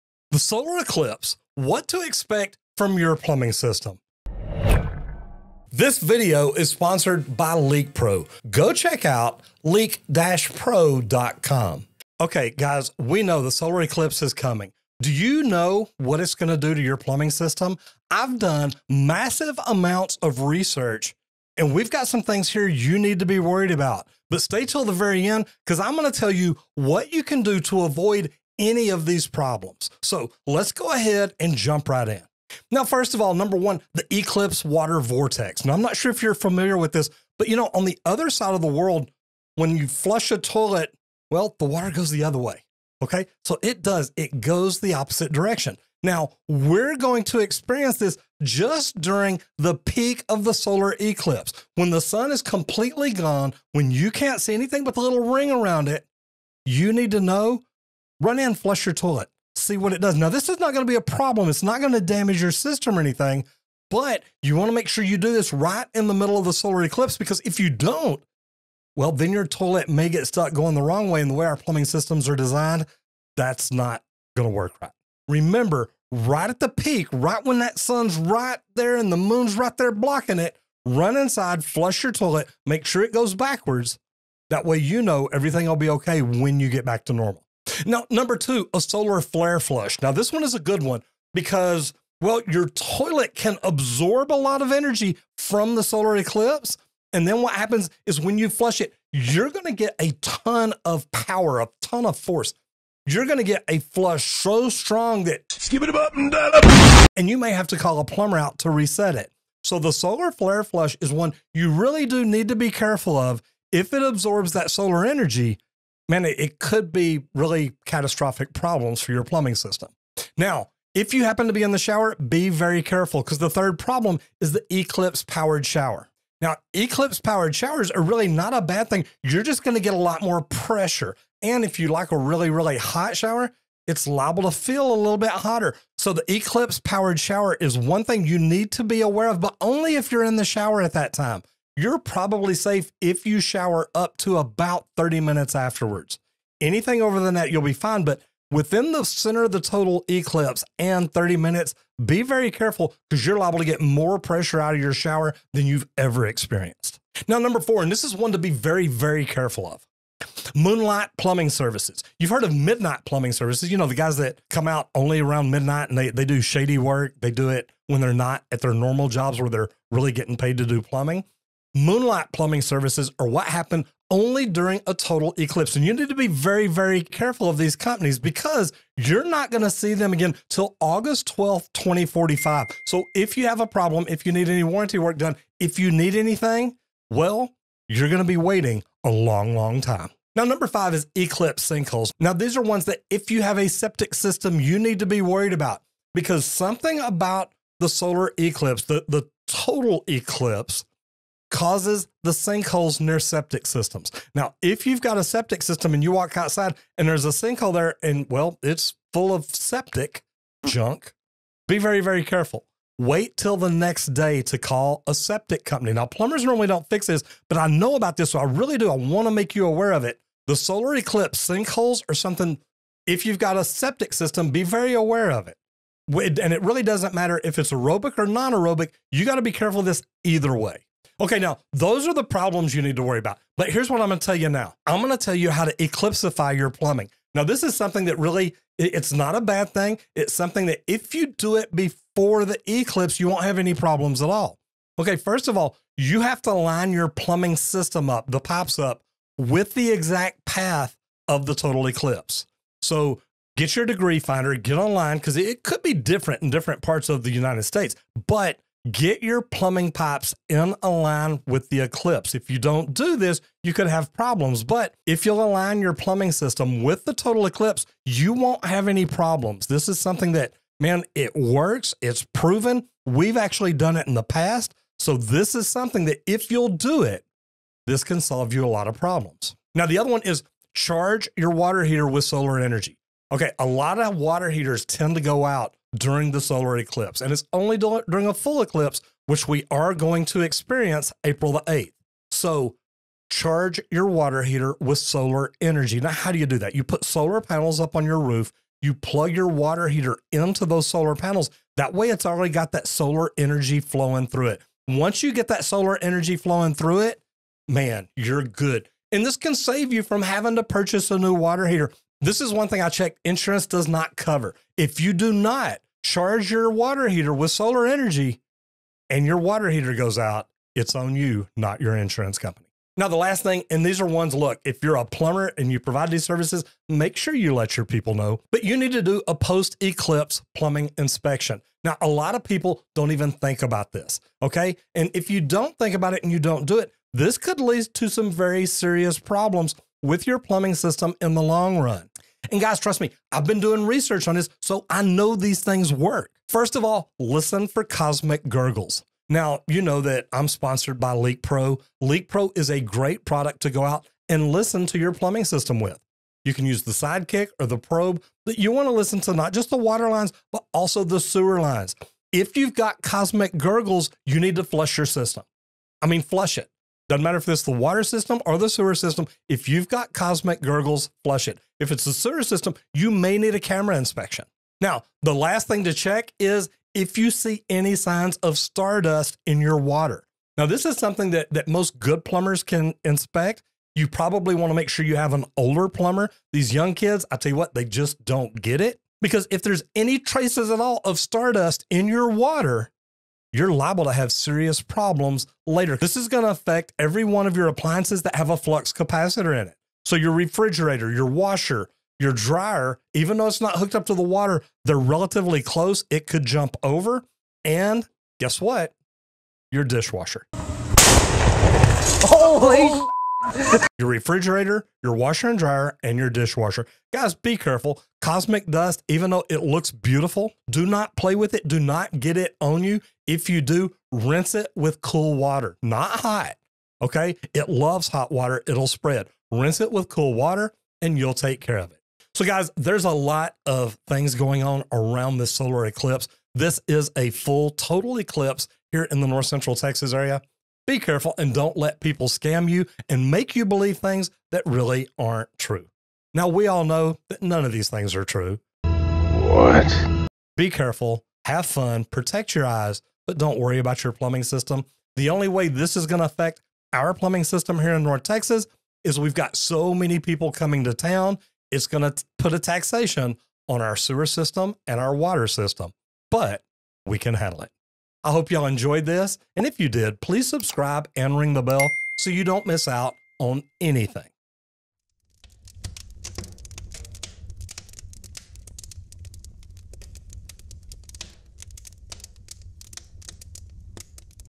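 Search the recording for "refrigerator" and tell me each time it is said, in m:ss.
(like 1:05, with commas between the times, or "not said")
6:40, 6:54.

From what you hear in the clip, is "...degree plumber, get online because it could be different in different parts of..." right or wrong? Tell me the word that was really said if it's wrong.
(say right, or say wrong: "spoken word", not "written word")
wrong: "finder", not "plumber".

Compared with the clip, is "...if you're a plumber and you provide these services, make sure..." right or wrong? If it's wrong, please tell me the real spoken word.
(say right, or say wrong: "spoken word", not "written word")
right.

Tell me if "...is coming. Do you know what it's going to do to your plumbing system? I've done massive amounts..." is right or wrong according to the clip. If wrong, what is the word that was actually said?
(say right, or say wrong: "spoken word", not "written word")
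right.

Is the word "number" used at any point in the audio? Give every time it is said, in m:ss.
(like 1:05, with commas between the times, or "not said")
0:33, 1:28, 2:37, 3:10.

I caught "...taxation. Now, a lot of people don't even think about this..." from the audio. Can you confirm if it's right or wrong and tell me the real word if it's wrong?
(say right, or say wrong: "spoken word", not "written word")
wrong: "inspection", not "taxation".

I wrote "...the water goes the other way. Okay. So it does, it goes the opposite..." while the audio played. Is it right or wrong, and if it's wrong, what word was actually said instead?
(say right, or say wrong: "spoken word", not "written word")
right.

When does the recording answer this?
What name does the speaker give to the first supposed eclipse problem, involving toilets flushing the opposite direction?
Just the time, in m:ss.
0:34.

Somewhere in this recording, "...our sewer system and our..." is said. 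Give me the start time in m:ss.
7:43.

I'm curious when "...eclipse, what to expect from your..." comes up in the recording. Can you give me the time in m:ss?
0:00.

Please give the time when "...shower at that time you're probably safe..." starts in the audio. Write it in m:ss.
2:20.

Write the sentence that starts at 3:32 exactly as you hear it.
Wait till the next day to call a septic company.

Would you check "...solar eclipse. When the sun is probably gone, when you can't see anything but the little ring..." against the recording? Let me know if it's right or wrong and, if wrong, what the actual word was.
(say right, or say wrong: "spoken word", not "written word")
wrong: "completely", not "probably".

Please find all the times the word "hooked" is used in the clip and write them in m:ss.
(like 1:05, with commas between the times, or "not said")
6:43.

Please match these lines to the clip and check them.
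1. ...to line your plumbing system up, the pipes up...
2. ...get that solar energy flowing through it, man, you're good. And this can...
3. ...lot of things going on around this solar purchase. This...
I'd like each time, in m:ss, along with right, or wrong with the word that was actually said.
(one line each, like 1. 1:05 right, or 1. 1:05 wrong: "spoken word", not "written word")
1. 4:06 right
2. 5:05 right
3. 7:13 wrong: "eclipse", not "purchase".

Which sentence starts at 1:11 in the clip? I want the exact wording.
And the way our plumbing systems are designed, that's not going to work right.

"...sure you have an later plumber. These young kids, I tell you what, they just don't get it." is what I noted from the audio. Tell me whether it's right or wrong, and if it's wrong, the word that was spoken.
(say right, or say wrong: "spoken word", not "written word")
wrong: "older", not "later".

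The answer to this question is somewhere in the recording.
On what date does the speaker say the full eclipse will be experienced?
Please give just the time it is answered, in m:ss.
4:51.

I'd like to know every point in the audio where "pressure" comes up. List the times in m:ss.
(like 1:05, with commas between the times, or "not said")
2:10, 2:34.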